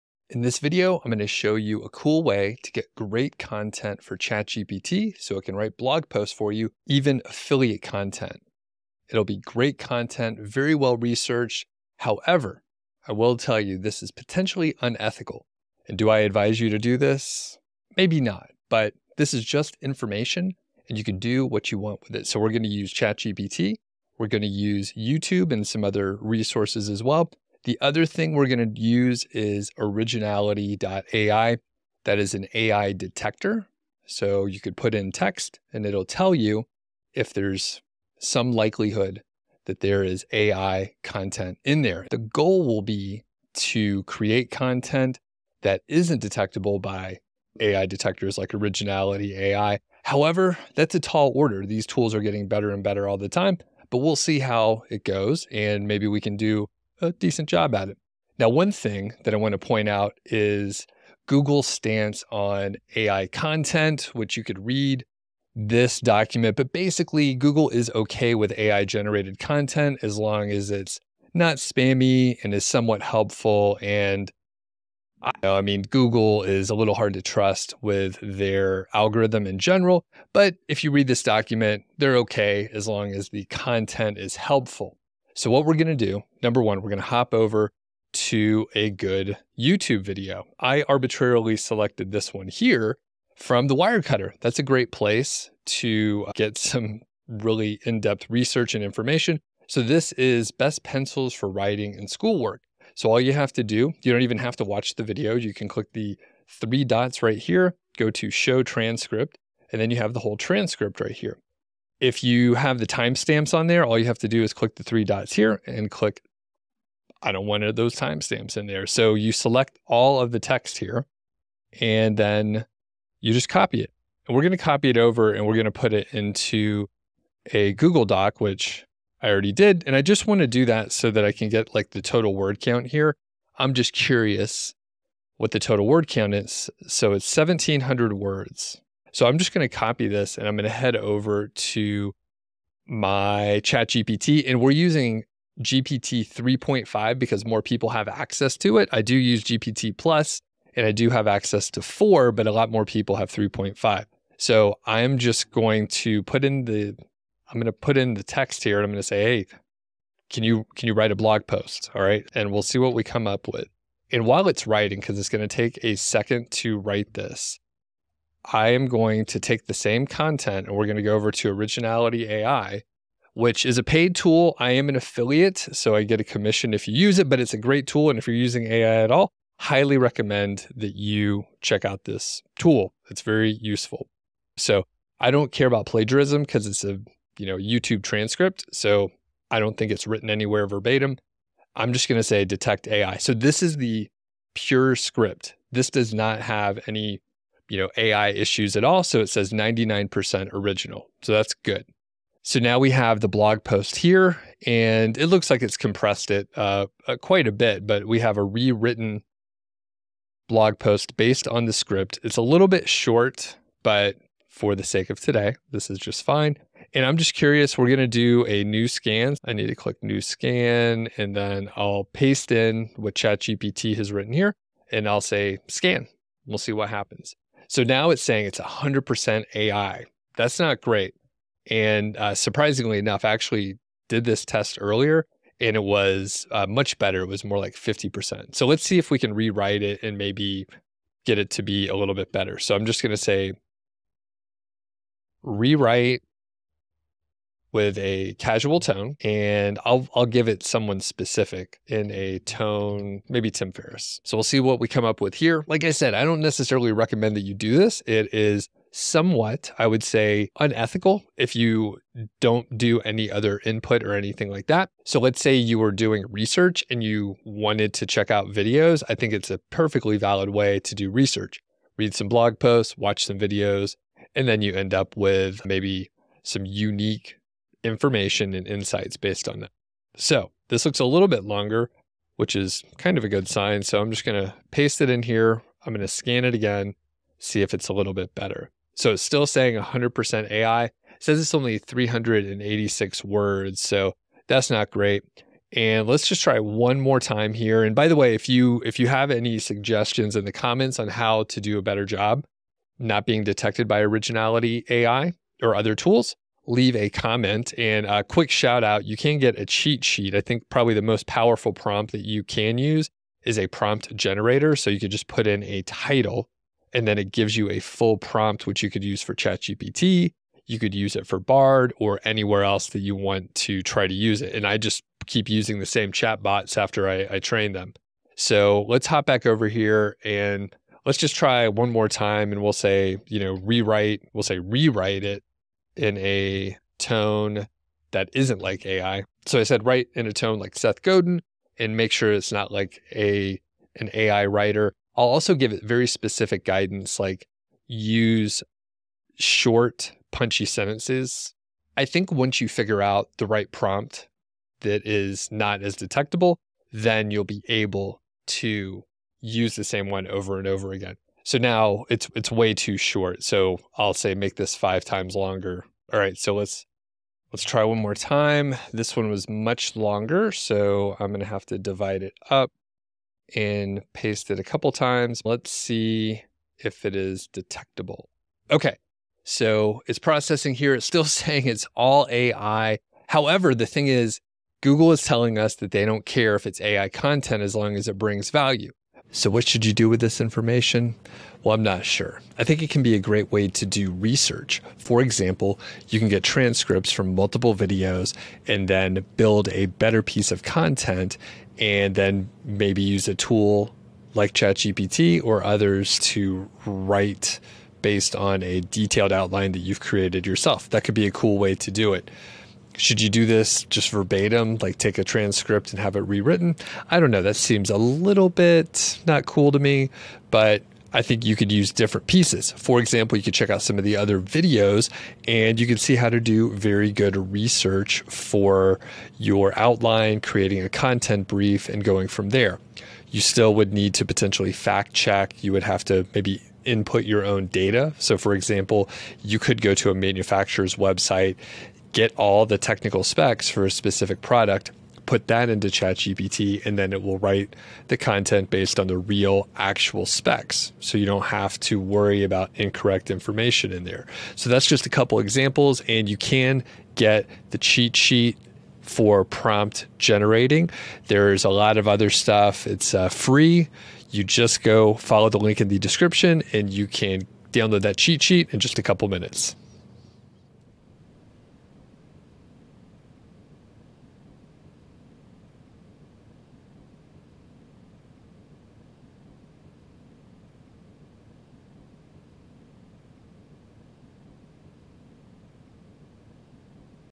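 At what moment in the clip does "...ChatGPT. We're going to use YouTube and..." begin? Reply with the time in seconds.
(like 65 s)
22 s.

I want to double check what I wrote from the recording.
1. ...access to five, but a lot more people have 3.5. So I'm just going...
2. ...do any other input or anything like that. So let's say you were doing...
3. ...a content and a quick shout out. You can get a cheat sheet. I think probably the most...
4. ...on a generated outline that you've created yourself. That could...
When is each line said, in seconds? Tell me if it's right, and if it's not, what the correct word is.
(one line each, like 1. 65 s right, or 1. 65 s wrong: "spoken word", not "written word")
1. 151 s wrong: "four", not "five"
2. 262 s right
3. 306 s wrong: "comment", not "content"
4. 408 s wrong: "detailed", not "generated".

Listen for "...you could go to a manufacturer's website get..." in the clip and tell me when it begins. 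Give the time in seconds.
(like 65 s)
439 s.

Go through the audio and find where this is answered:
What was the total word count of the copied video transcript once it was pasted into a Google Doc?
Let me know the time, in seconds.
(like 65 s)
137 s.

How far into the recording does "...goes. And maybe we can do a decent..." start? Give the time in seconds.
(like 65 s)
55 s.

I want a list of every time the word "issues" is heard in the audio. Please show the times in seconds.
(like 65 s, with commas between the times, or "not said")
198 s.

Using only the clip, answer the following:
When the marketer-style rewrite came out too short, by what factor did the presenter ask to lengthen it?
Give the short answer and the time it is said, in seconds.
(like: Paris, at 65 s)
5 times, at 364 s.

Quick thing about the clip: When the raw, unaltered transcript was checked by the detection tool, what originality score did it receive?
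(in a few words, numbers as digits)
99%.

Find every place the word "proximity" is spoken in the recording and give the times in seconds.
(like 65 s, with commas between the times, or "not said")
not said.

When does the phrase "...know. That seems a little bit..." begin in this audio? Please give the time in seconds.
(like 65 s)
417 s.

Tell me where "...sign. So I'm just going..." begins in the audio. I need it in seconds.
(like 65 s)
283 s.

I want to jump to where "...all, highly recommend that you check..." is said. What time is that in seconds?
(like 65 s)
179 s.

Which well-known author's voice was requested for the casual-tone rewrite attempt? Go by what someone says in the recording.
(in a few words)
Tim Ferriss.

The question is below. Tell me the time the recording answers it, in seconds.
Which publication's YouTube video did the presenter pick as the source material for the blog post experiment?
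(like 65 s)
93 s.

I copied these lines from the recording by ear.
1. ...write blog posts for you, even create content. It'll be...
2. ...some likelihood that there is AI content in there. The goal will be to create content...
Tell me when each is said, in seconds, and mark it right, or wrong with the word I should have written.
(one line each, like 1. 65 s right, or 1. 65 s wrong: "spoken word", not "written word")
1. 5 s wrong: "affiliate", not "create"
2. 38 s right.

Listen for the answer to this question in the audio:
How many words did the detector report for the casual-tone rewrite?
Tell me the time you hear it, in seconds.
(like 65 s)
291 s.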